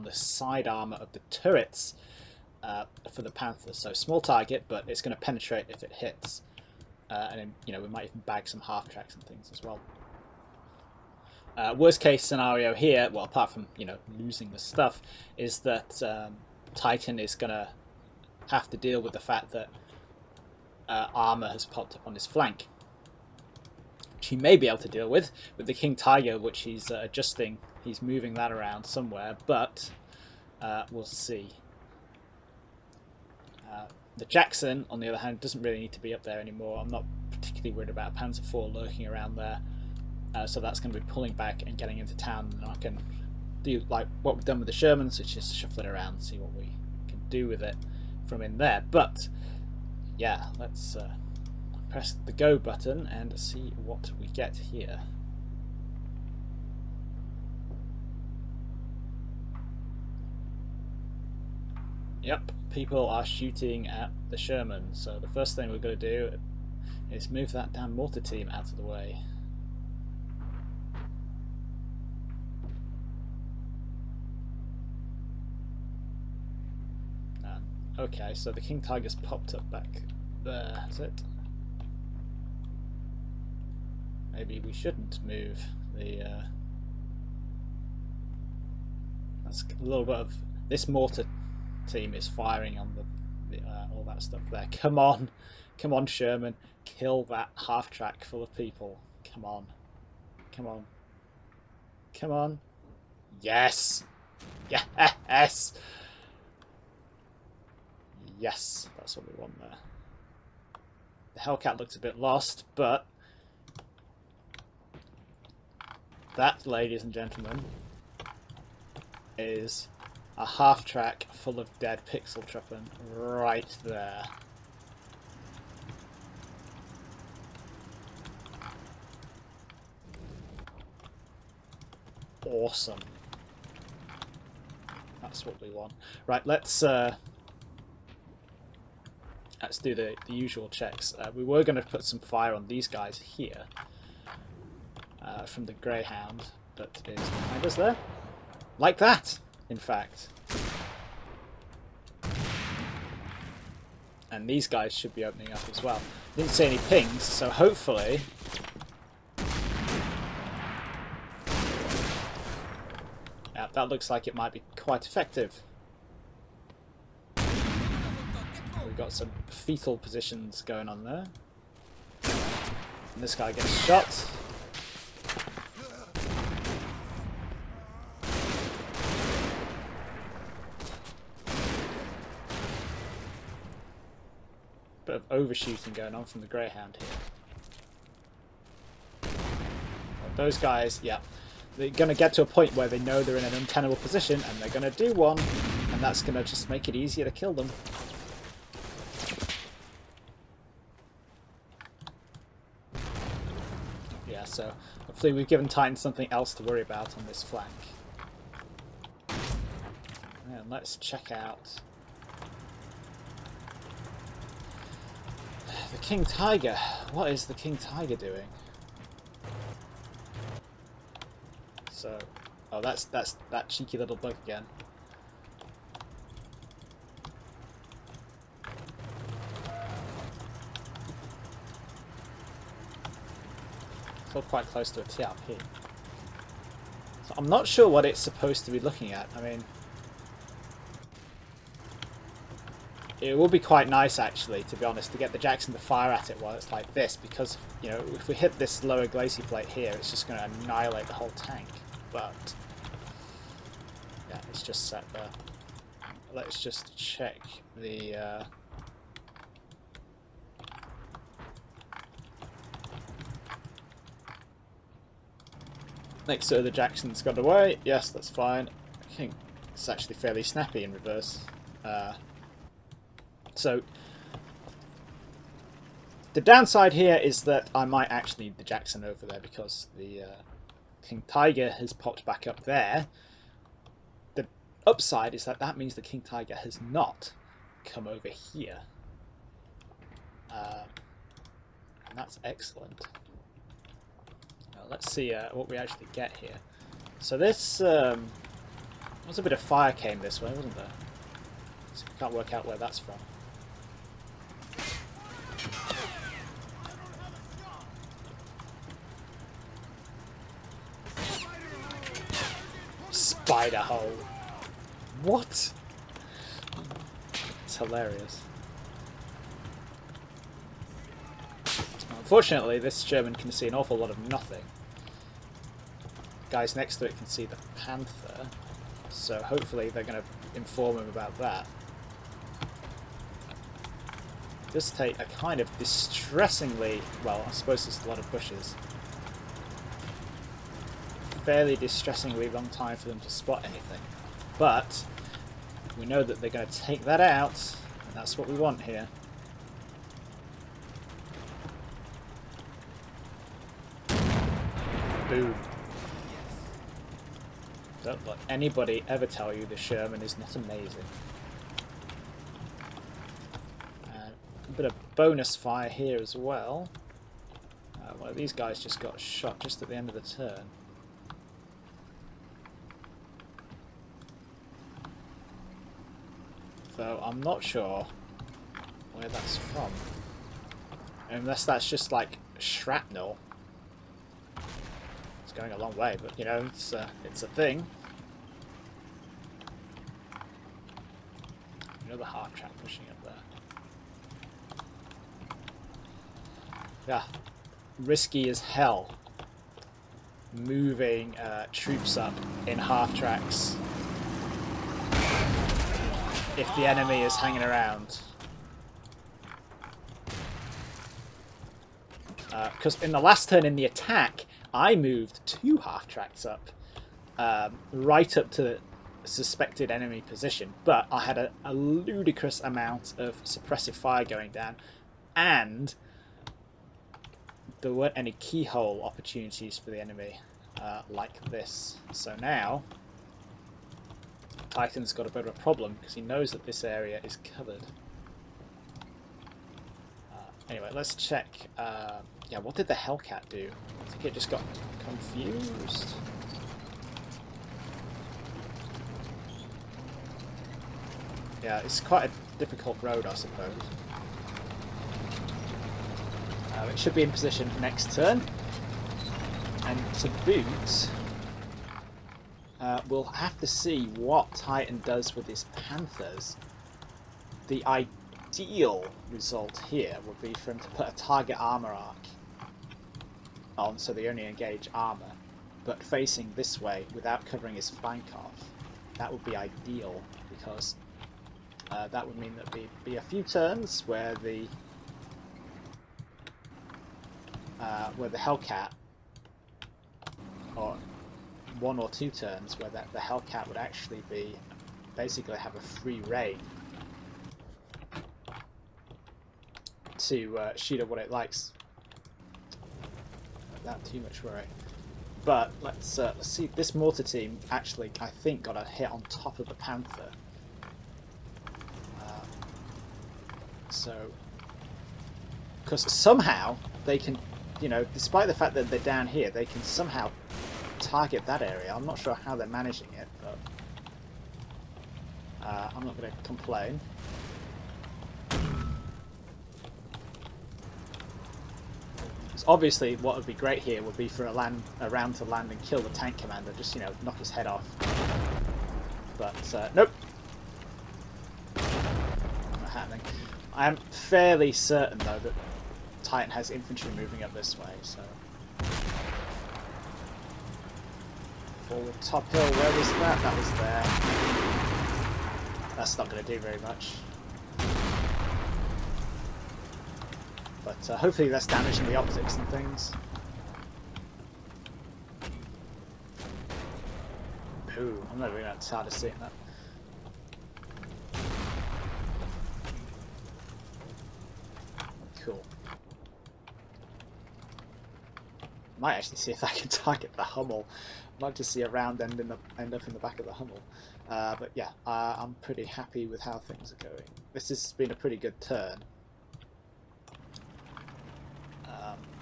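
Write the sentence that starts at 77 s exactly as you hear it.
okay, so the King Tiger's popped up back there.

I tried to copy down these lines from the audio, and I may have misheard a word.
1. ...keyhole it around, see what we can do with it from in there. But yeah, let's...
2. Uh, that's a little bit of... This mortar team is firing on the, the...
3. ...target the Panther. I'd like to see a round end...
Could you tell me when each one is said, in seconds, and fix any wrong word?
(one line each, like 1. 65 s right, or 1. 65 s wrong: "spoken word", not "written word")
1. 45 s wrong: "shuffle", not "keyhole"
2. 86 s right
3. 579 s wrong: "Hummel", not "Panther".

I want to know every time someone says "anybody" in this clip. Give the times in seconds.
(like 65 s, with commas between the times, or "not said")
358 s.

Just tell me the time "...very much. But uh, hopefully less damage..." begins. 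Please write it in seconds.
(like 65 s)
556 s.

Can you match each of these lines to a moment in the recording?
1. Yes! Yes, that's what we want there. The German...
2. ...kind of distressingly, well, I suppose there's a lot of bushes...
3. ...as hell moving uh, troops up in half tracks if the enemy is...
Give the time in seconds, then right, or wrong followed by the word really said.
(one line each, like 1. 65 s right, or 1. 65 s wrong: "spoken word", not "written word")
1. 104 s wrong: "Hellcat", not "German"
2. 335 s right
3. 398 s right.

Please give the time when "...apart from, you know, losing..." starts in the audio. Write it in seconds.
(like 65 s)
13 s.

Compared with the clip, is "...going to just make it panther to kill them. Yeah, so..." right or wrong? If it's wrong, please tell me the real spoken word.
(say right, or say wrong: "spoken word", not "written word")
wrong: "easier", not "panther".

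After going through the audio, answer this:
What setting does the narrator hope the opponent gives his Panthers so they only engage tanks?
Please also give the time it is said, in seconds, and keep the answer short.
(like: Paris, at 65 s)
Target armor arc, at 471 s.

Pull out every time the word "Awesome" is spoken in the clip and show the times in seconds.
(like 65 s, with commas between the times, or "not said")
132 s.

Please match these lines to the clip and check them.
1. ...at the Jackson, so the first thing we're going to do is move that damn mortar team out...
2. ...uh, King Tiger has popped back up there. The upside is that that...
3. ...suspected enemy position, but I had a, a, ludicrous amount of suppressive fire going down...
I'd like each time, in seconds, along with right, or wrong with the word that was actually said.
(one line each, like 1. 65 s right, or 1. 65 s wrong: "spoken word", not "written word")
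1. 63 s wrong: "Sherman", not "Jackson"
2. 280 s right
3. 419 s right.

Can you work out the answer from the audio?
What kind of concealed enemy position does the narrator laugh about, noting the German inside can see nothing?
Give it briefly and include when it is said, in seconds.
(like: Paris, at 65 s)
Spider hole, at 313 s.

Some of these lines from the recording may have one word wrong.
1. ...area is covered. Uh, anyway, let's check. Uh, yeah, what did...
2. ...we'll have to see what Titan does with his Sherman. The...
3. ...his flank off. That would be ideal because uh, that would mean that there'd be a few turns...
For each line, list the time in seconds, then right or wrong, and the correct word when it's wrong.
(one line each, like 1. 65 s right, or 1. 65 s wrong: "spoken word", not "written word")
1. 436 s right
2. 463 s wrong: "Panthers", not "Sherman"
3. 477 s right.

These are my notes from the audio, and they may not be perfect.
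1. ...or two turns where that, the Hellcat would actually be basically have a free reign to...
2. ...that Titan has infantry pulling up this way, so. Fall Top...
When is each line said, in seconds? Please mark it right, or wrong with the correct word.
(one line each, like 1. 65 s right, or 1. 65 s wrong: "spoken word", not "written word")
1. 491 s right
2. 545 s wrong: "moving", not "pulling".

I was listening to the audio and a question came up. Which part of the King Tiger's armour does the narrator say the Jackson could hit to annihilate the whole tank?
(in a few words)
Lower glacis plate.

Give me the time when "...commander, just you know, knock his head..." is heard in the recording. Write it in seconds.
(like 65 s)
536 s.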